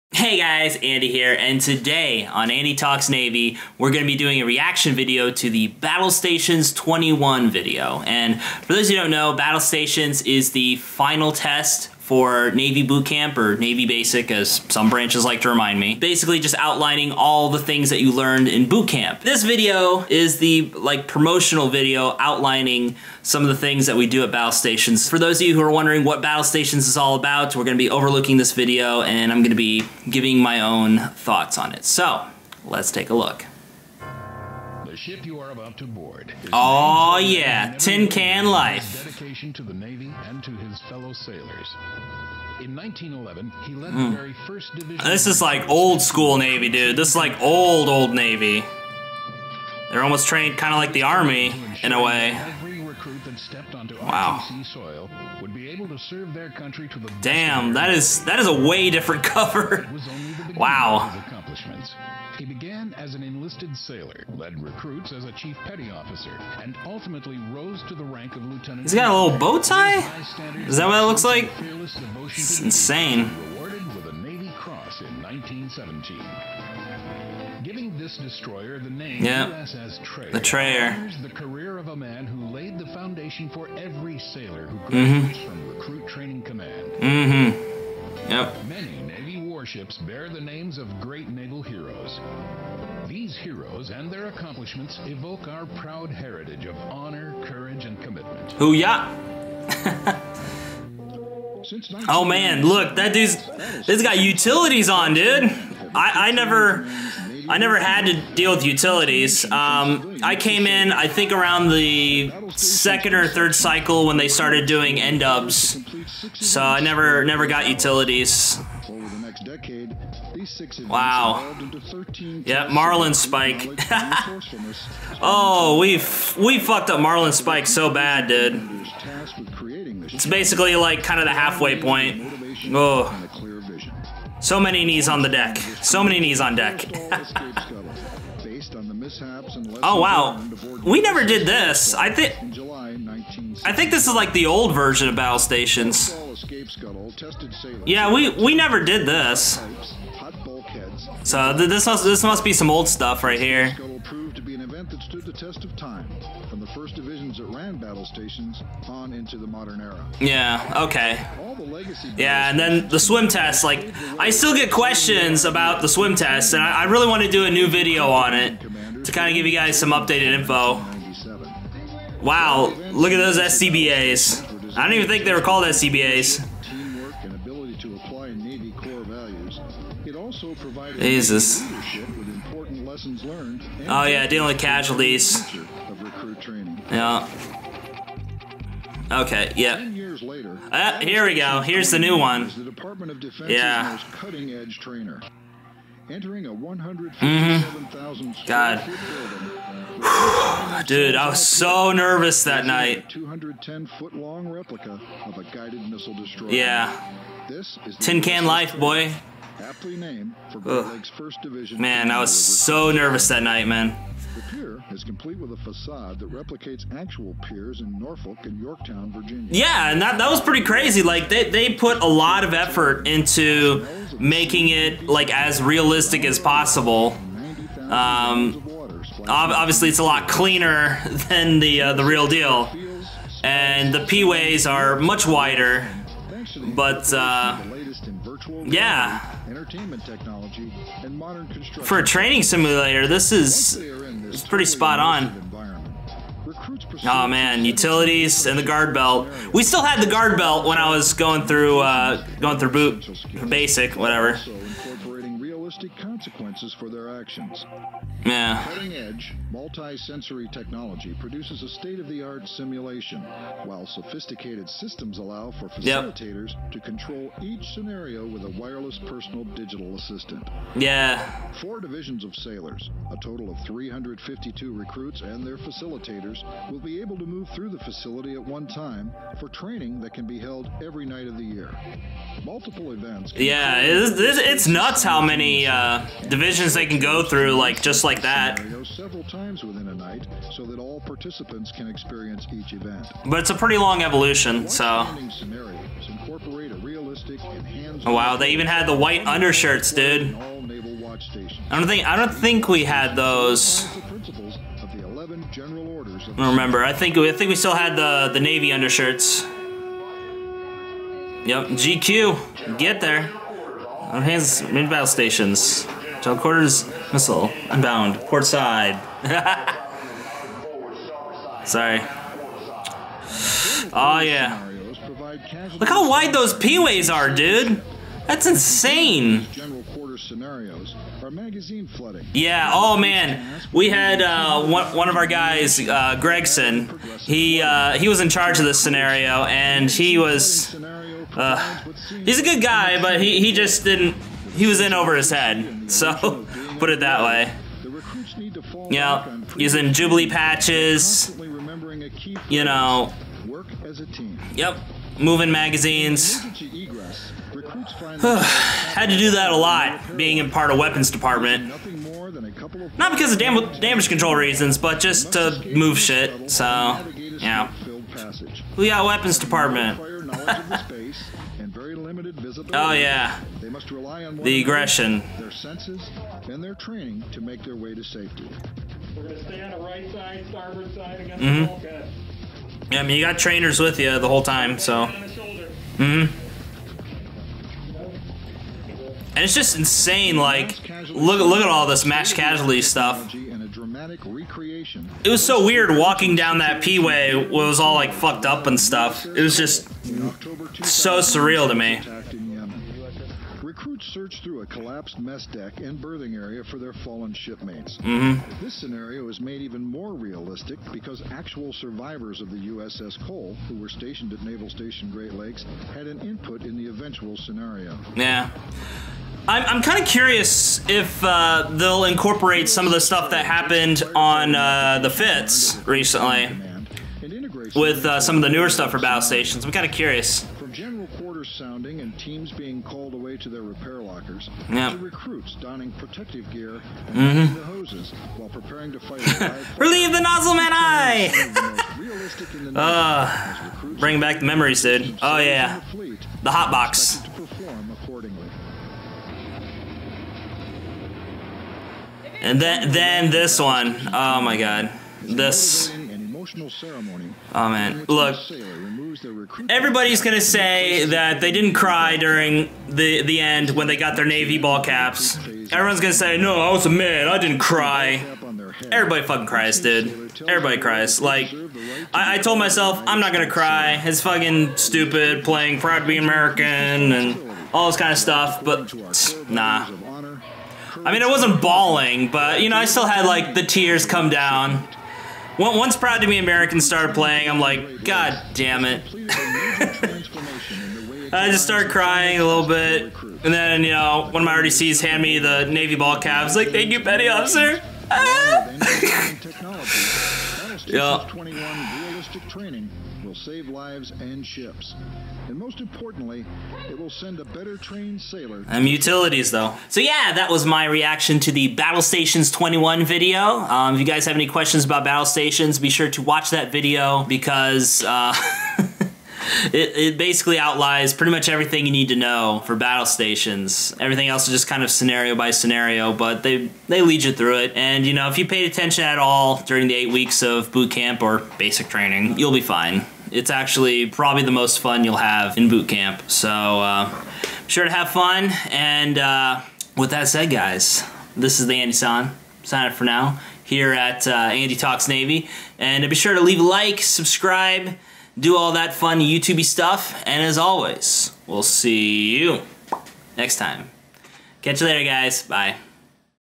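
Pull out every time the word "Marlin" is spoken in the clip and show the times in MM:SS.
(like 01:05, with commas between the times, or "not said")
02:02, 02:07.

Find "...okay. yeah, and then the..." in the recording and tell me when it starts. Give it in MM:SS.
02:40.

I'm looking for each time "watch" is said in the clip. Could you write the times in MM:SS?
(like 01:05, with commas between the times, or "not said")
08:36.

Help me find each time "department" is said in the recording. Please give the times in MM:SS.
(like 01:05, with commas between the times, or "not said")
06:01, 06:09.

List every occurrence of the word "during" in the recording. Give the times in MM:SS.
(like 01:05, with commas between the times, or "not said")
07:42, 08:49.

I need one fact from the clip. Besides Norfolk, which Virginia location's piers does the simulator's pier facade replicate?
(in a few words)
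Yorktown.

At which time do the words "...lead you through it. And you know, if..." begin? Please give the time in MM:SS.
08:47.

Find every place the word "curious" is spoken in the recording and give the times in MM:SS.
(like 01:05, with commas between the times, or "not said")
07:00, 07:09.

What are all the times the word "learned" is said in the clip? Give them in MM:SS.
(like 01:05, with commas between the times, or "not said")
00:18, 03:03.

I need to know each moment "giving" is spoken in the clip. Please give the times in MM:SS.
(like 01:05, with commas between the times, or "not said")
00:30, 01:17.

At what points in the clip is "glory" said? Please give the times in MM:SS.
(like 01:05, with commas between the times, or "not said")
not said.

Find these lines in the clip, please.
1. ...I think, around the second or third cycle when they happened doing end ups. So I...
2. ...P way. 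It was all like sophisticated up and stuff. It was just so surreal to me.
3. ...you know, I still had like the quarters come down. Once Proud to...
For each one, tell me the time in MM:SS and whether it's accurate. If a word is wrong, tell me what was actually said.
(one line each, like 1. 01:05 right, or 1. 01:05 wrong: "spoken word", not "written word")
1. 01:50 wrong: "started", not "happened"
2. 06:36 wrong: "fucked", not "sophisticated"
3. 08:02 wrong: "tears", not "quarters".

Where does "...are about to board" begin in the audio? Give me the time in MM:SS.
00:35.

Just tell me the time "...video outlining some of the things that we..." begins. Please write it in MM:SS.
00:21.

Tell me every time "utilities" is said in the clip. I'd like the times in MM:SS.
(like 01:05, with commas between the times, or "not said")
01:44, 01:48, 01:57, 04:07, 08:28.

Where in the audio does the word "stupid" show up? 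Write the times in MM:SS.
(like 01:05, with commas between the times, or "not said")
07:54.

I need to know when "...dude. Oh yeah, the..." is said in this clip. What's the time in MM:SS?
07:24.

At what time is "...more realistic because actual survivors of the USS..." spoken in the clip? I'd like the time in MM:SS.
06:49.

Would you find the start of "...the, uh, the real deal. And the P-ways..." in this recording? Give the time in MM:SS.
03:51.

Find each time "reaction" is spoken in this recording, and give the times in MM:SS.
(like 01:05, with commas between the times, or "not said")
00:04, 08:30.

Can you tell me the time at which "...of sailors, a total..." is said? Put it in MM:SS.
04:32.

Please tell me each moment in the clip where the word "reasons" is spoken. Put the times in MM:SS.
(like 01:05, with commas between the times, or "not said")
06:04.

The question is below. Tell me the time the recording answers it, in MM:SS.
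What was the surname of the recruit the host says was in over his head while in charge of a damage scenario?
05:36.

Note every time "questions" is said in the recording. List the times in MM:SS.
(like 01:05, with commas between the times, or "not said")
02:44, 08:34.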